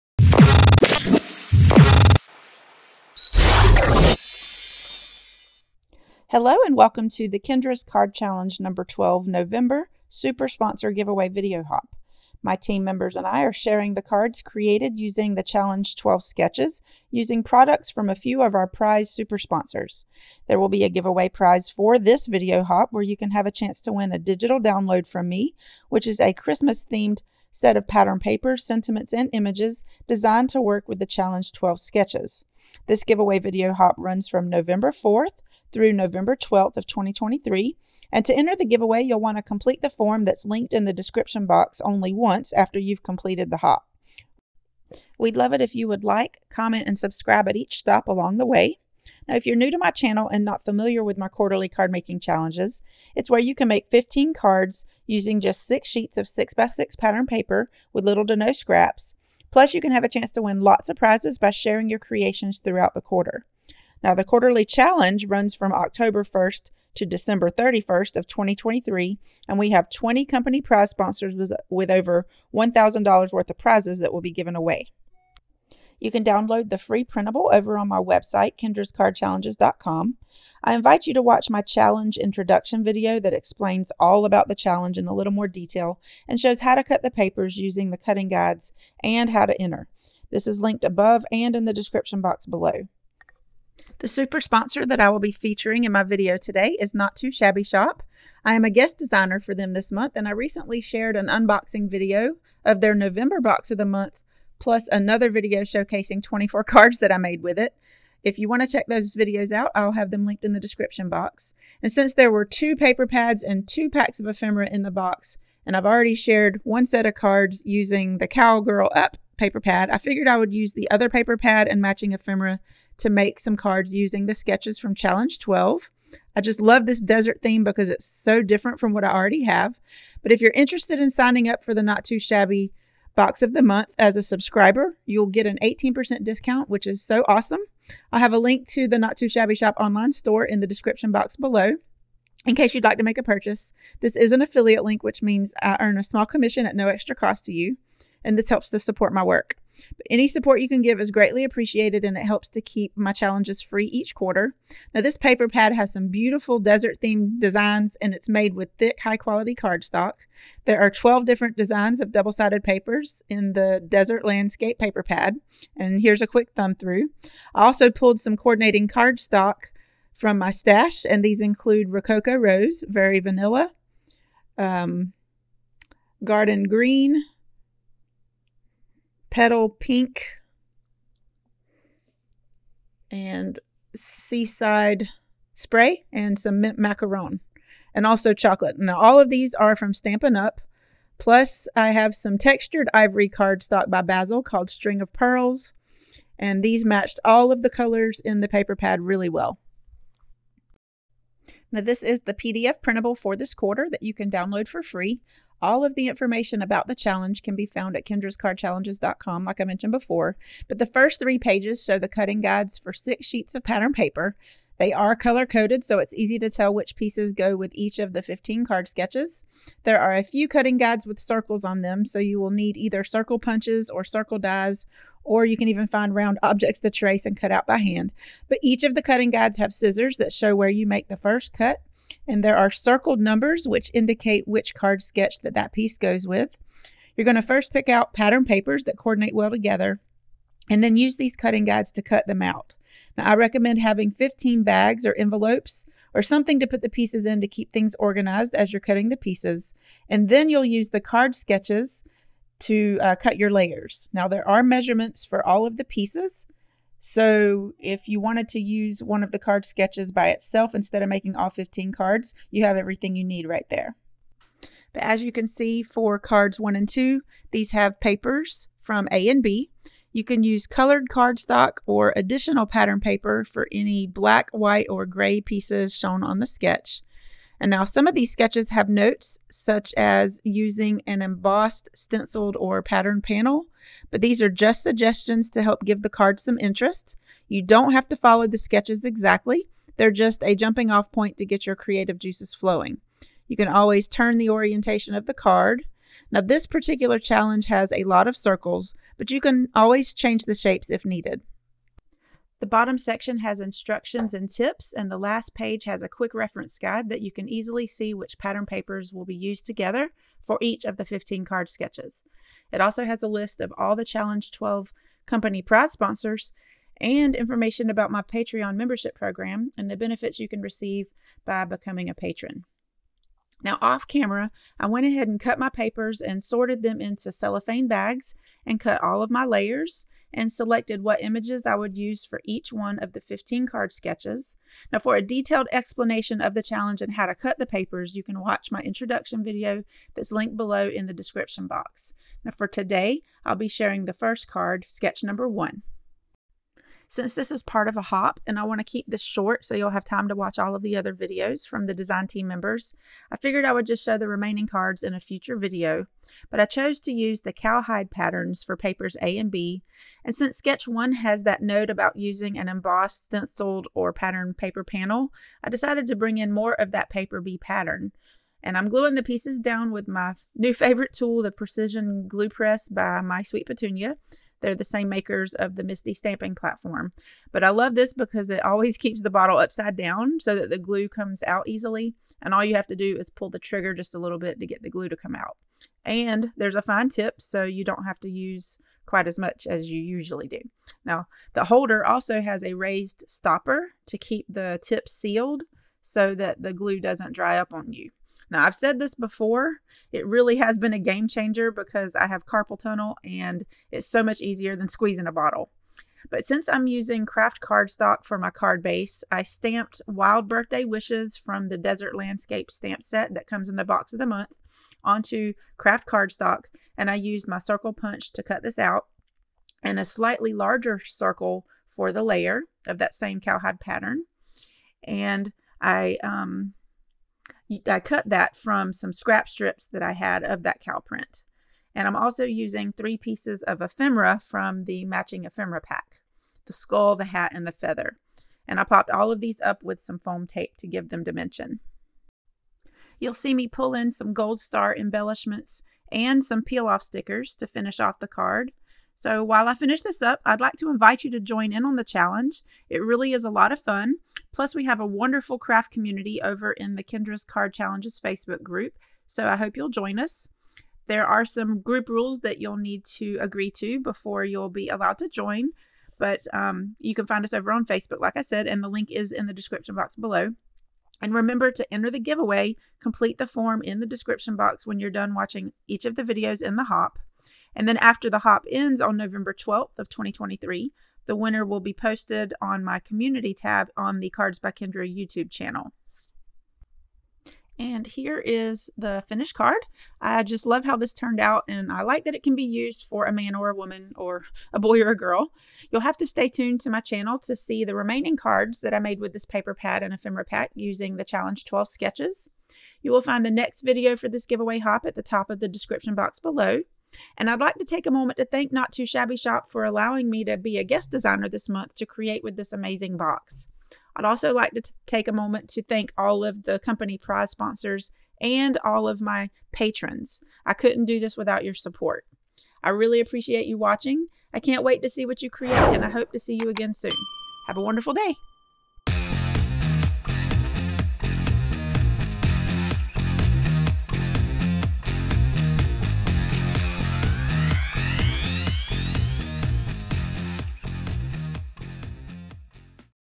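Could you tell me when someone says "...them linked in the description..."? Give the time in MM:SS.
01:50.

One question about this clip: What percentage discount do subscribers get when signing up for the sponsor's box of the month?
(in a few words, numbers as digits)
18%.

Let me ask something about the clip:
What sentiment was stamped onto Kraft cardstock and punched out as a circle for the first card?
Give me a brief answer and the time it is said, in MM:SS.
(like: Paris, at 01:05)
Wild Birthday Wishes, at 06:50.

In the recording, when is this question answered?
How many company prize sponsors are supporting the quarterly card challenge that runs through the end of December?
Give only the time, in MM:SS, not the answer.
01:09.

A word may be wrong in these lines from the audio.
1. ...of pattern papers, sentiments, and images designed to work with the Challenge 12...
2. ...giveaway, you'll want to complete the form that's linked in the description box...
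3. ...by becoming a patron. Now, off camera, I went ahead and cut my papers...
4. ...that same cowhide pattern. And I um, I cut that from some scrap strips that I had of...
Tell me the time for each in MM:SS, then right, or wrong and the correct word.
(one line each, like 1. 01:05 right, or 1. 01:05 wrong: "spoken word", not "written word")
1. 00:27 right
2. 00:38 right
3. 05:21 right
4. 07:02 right.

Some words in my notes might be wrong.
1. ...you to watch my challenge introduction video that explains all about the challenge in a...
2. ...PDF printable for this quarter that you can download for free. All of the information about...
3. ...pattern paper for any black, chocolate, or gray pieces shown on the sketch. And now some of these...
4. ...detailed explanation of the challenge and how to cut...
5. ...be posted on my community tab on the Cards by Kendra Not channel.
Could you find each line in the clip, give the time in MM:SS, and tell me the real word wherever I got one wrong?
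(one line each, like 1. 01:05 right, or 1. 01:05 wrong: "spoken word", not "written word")
1. 01:21 right
2. 03:22 right
3. 04:32 wrong: "white", not "chocolate"
4. 05:35 right
5. 08:01 wrong: "YouTube", not "Not".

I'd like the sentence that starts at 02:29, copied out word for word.
But any support you can give is greatly appreciated and it helps to keep my challenges free each quarter.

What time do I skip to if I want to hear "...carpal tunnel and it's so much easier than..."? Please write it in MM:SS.
06:42.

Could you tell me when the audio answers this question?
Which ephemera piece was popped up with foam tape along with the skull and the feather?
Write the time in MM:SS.
07:17.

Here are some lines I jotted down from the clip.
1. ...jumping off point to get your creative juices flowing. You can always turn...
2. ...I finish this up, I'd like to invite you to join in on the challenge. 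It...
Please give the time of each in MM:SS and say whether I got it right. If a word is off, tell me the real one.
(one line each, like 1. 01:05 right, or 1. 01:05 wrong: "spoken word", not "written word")
1. 04:50 right
2. 07:29 right.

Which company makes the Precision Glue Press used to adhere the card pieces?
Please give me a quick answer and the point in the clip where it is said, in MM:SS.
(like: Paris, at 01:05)
My Sweet Petunia, at 06:13.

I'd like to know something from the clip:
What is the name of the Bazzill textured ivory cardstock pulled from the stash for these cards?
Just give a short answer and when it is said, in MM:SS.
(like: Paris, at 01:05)
String of Pearls, at 03:14.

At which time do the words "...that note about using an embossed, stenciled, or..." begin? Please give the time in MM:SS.
06:01.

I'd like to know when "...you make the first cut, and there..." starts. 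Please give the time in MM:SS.
03:50.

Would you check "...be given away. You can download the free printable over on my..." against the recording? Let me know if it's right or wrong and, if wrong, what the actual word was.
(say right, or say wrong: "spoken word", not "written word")
right.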